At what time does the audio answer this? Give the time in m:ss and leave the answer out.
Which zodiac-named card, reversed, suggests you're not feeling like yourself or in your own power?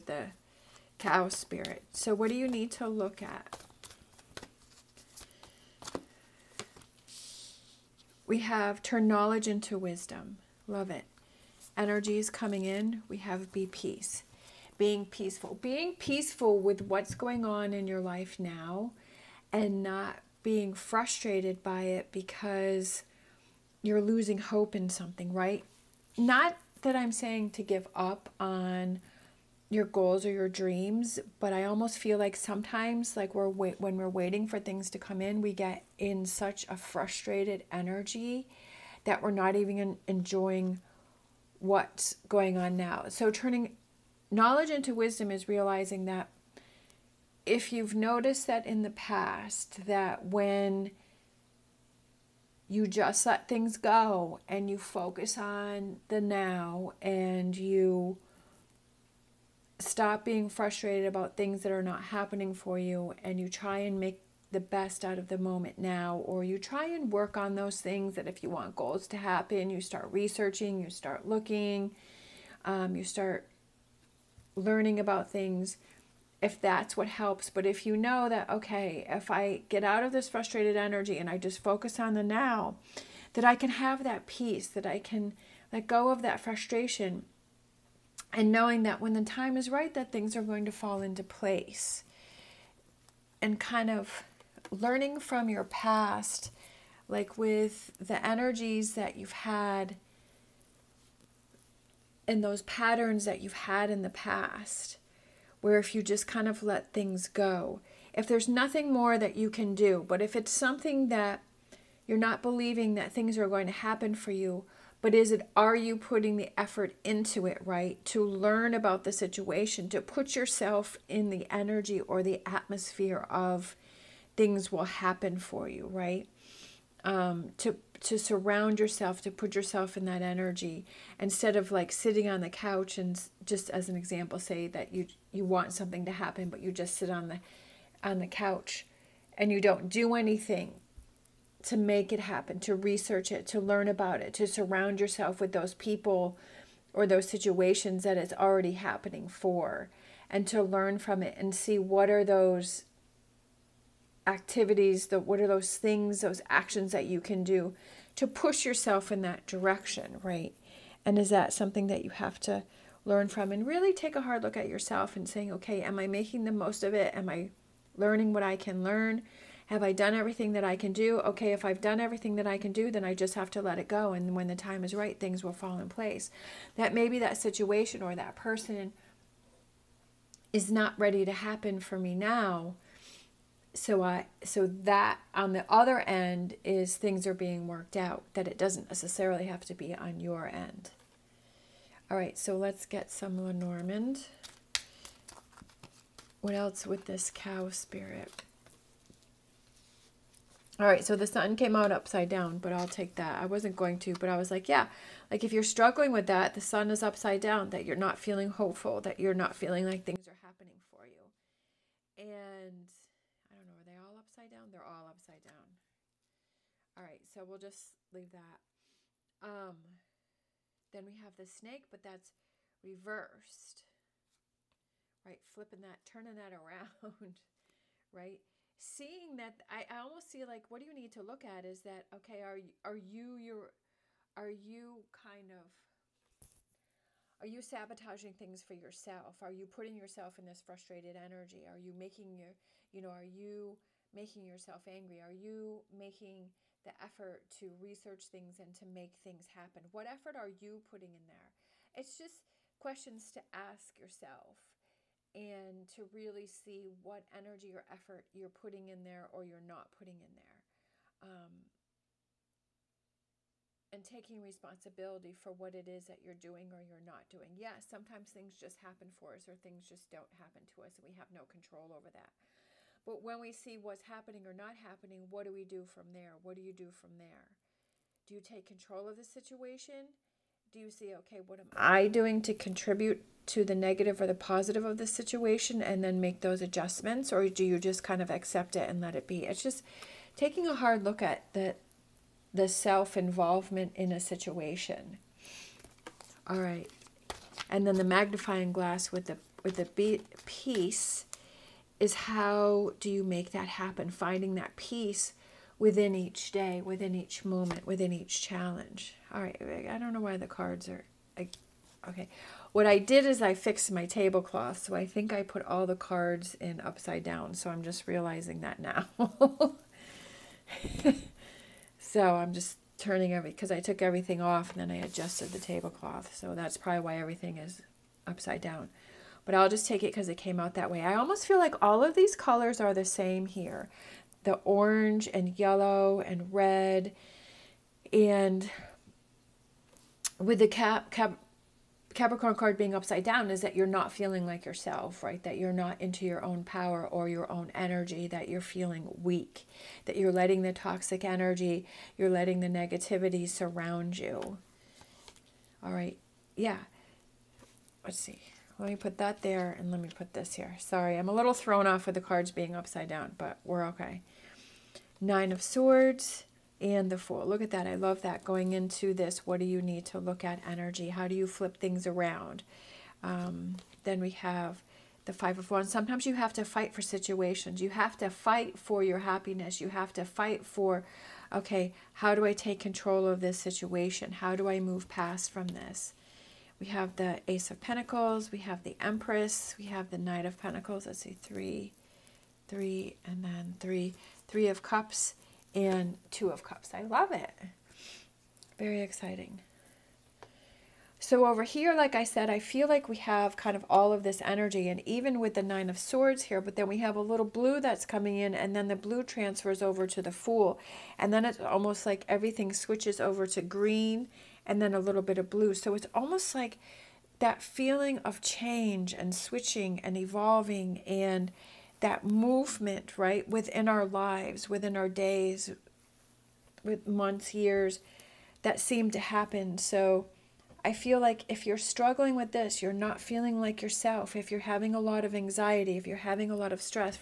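5:42.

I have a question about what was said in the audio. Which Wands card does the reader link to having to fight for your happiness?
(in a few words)
Five of Wands.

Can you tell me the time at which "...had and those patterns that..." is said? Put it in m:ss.
1:39.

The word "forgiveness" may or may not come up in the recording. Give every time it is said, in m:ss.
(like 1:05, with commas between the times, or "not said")
not said.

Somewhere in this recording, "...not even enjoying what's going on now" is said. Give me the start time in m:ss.
0:39.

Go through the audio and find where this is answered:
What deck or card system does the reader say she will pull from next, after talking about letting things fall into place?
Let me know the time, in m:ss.
3:13.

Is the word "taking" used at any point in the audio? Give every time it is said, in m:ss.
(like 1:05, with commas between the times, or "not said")
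4:24, 4:50.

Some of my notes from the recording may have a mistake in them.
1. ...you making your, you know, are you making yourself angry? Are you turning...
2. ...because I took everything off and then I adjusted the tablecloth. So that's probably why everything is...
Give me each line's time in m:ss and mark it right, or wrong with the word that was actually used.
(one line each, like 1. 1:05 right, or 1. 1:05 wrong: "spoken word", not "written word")
1. 4:01 wrong: "making", not "turning"
2. 5:23 right.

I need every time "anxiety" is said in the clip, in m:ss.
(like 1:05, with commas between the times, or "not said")
7:15.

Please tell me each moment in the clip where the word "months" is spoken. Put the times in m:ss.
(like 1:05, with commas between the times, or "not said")
7:07.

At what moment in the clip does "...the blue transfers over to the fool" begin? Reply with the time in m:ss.
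6:48.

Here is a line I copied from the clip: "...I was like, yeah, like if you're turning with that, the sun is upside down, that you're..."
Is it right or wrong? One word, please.
wrong.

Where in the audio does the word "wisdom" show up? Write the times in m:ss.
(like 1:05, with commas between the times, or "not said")
0:09, 0:44.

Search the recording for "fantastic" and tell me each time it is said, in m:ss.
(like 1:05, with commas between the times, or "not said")
not said.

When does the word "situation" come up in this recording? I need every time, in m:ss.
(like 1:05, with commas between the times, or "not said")
1:59, 2:27, 2:57, 4:39, 4:45, 4:54, 6:17, 6:23.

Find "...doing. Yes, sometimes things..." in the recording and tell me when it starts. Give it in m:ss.
4:27.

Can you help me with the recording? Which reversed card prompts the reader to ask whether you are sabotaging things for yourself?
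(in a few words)
The snake.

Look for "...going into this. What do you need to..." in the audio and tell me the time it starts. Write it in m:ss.
6:08.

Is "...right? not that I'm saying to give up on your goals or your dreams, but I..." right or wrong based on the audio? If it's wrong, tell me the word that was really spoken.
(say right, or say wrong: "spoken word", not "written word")
right.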